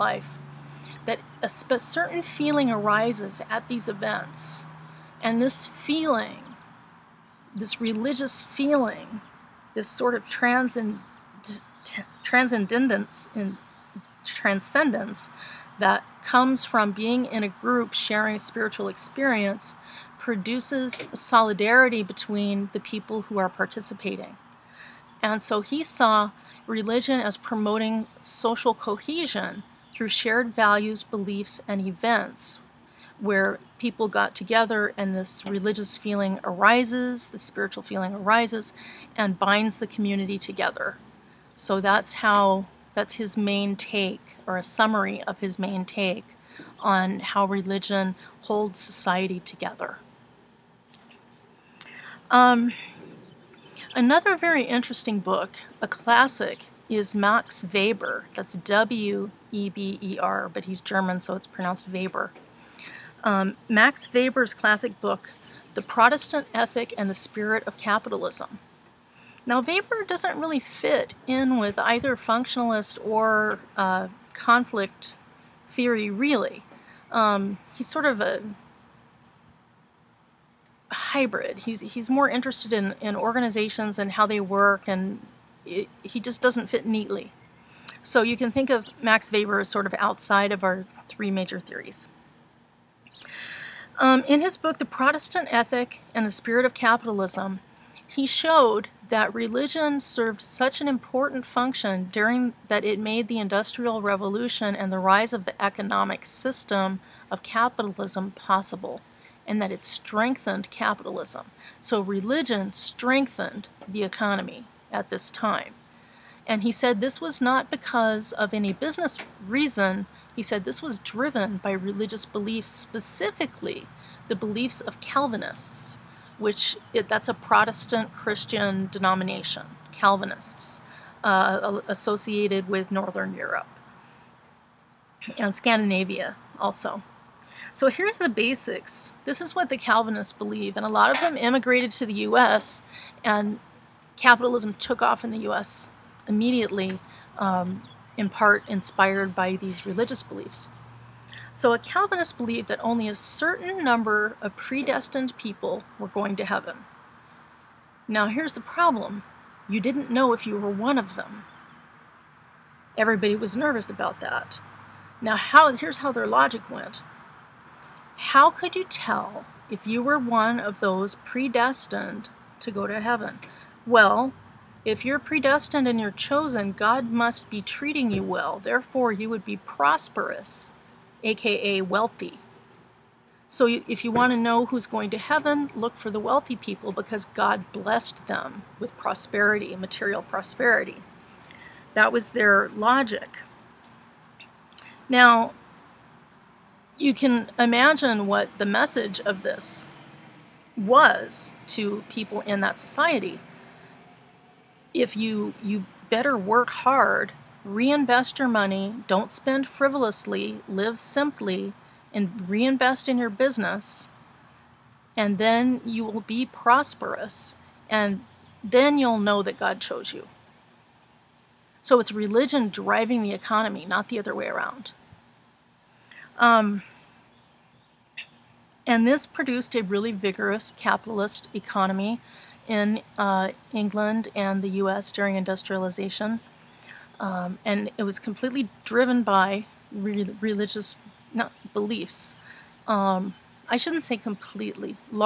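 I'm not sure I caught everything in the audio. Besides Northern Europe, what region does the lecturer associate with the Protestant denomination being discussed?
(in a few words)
Scandinavia.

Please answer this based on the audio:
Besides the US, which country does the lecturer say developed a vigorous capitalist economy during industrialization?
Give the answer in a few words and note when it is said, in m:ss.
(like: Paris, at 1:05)
England, at 3:53.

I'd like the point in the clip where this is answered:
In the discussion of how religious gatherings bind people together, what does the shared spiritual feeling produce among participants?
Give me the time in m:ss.
0:21.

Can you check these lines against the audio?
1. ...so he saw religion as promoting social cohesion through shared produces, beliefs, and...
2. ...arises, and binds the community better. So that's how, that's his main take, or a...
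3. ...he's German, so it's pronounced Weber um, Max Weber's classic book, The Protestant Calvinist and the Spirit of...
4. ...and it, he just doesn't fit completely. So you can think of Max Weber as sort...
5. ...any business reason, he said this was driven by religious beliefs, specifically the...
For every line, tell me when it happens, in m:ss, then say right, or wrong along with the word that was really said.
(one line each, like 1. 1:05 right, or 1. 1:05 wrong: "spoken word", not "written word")
1. 0:25 wrong: "values", not "produces"
2. 0:38 wrong: "together", not "better"
3. 1:00 wrong: "Ethic", not "Calvinist"
4. 1:24 wrong: "neatly", not "completely"
5. 1:58 right.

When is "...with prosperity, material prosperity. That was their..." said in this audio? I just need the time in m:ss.
3:08.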